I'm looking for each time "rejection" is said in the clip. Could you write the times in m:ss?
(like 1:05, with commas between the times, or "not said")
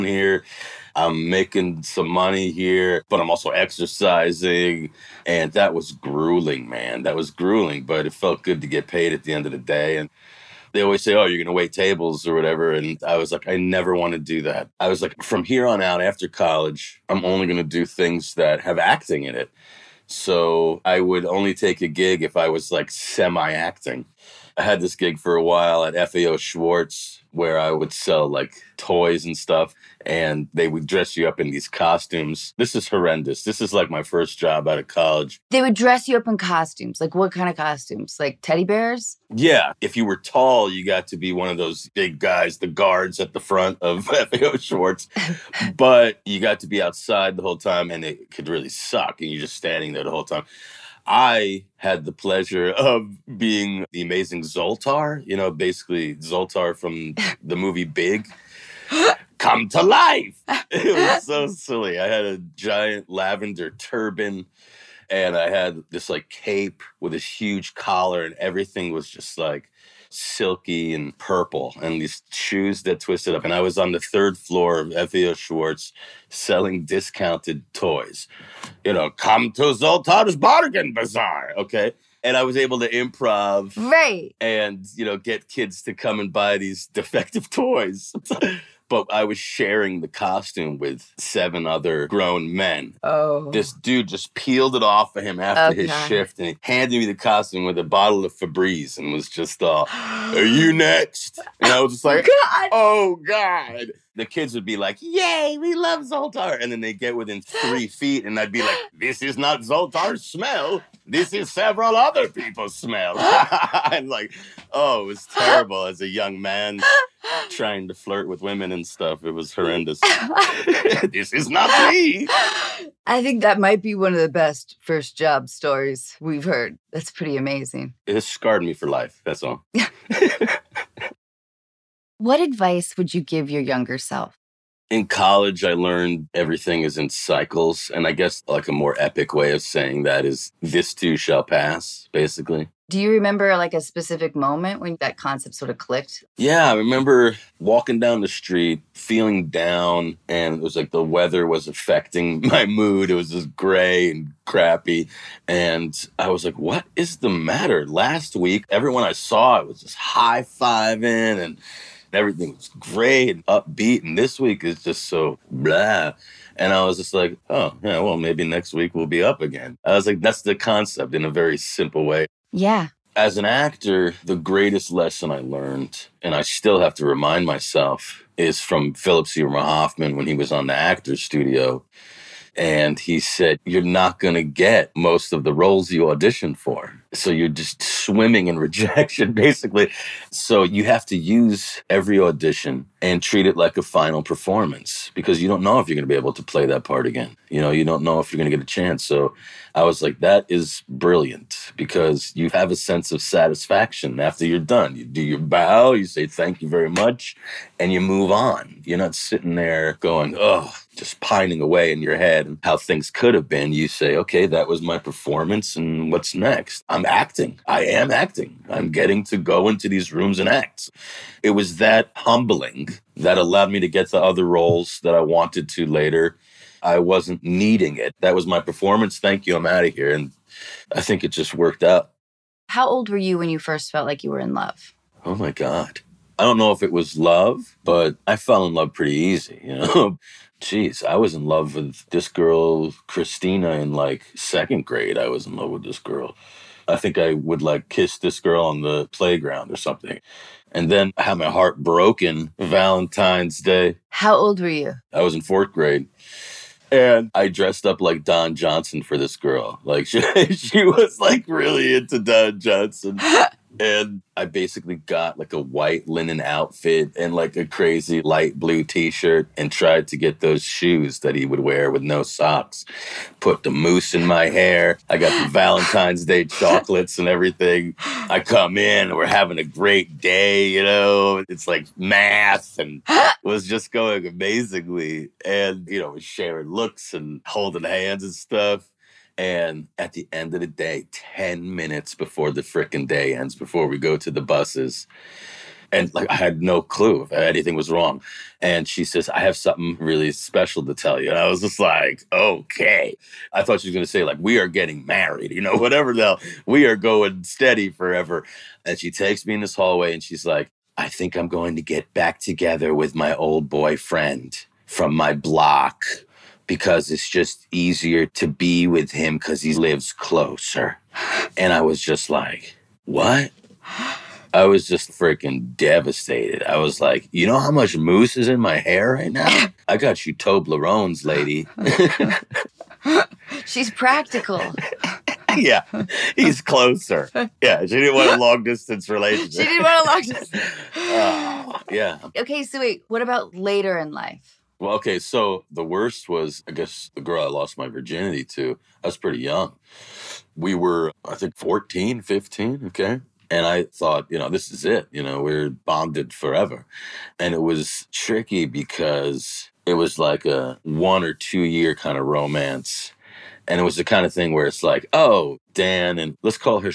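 3:08.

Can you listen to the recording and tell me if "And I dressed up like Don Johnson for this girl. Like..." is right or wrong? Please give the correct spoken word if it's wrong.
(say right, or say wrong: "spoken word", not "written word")
right.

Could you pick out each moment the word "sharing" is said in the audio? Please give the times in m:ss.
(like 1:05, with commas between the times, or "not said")
1:29, 4:46.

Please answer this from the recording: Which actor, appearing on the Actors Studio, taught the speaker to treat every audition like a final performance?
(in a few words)
Philip Seymour Hoffman.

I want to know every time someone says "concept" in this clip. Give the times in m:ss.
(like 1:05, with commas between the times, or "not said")
2:25, 2:50.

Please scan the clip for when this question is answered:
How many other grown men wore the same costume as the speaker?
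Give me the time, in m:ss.
1:31.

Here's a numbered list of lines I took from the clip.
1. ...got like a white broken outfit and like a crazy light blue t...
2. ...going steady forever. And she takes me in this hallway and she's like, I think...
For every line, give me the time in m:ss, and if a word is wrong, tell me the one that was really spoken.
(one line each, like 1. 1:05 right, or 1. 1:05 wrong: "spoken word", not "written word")
1. 4:24 wrong: "linen", not "broken"
2. 5:06 right.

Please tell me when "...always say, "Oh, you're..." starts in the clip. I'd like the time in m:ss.
0:10.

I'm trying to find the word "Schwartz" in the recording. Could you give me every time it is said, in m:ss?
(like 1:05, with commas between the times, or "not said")
0:26, 0:44, 1:15.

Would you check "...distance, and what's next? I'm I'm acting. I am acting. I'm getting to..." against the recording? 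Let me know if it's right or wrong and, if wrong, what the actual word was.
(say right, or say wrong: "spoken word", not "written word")
wrong: "performance", not "distance".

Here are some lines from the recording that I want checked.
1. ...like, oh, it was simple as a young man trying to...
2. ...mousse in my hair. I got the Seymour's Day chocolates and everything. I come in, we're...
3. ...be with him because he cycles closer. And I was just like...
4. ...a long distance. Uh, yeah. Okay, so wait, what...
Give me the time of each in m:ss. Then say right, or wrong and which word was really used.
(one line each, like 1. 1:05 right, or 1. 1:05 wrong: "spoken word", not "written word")
1. 1:54 wrong: "terrible", not "simple"
2. 4:33 wrong: "Valentine", not "Seymour"
3. 5:18 wrong: "lives", not "cycles"
4. 5:40 right.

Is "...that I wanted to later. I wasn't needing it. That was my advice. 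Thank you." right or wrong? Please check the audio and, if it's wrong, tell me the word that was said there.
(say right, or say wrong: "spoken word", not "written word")
wrong: "performance", not "advice".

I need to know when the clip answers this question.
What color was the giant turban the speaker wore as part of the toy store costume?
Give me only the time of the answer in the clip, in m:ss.
1:03.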